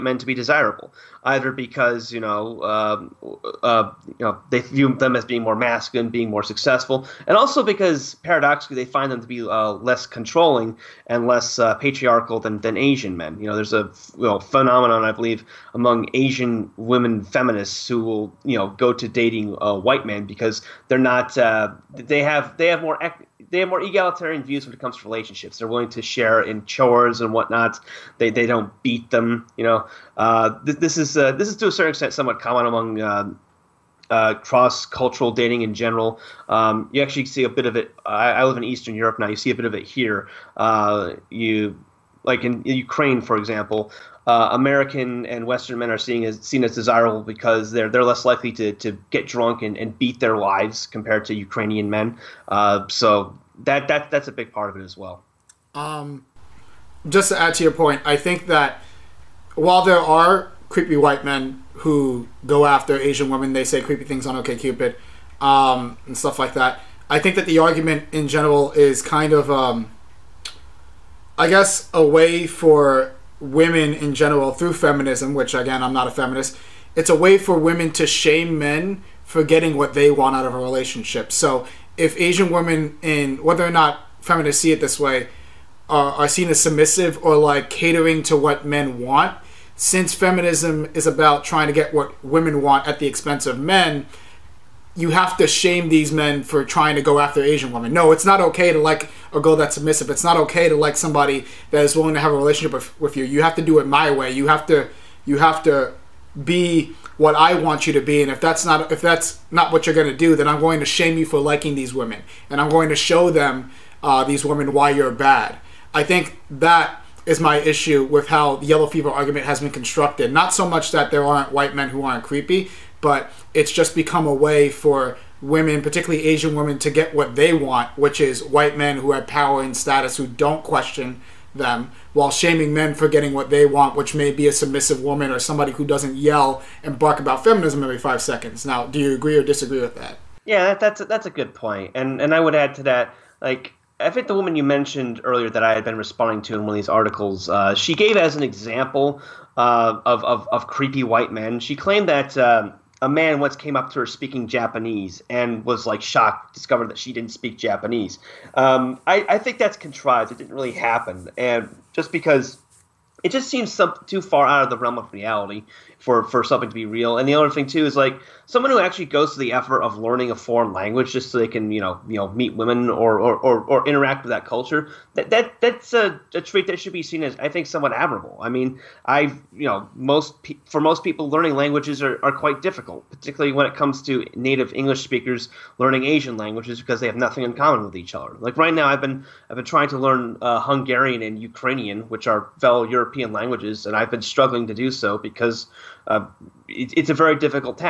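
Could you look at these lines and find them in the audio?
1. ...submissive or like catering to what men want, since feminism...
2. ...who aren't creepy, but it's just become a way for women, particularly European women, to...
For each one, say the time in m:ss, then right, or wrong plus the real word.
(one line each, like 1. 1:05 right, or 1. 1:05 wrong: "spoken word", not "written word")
1. 1:26 right
2. 2:01 wrong: "Asian", not "European".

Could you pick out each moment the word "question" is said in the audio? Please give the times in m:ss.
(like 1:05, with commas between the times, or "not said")
2:10.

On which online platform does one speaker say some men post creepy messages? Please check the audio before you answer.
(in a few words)
Cupid.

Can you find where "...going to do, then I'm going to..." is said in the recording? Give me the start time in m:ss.
1:49.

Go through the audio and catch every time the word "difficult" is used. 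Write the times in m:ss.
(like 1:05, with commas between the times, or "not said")
3:02, 3:17.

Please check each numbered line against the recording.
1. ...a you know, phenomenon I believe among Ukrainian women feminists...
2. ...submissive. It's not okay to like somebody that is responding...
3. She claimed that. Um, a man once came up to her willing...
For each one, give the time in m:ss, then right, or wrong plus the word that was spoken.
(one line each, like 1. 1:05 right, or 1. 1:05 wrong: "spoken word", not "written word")
1. 0:13 wrong: "Asian", not "Ukrainian"
2. 1:39 wrong: "willing", not "responding"
3. 2:31 wrong: "speaking", not "willing".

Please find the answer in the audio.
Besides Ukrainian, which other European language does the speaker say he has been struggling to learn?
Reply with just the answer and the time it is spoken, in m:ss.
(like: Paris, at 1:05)
Hungarian, at 3:10.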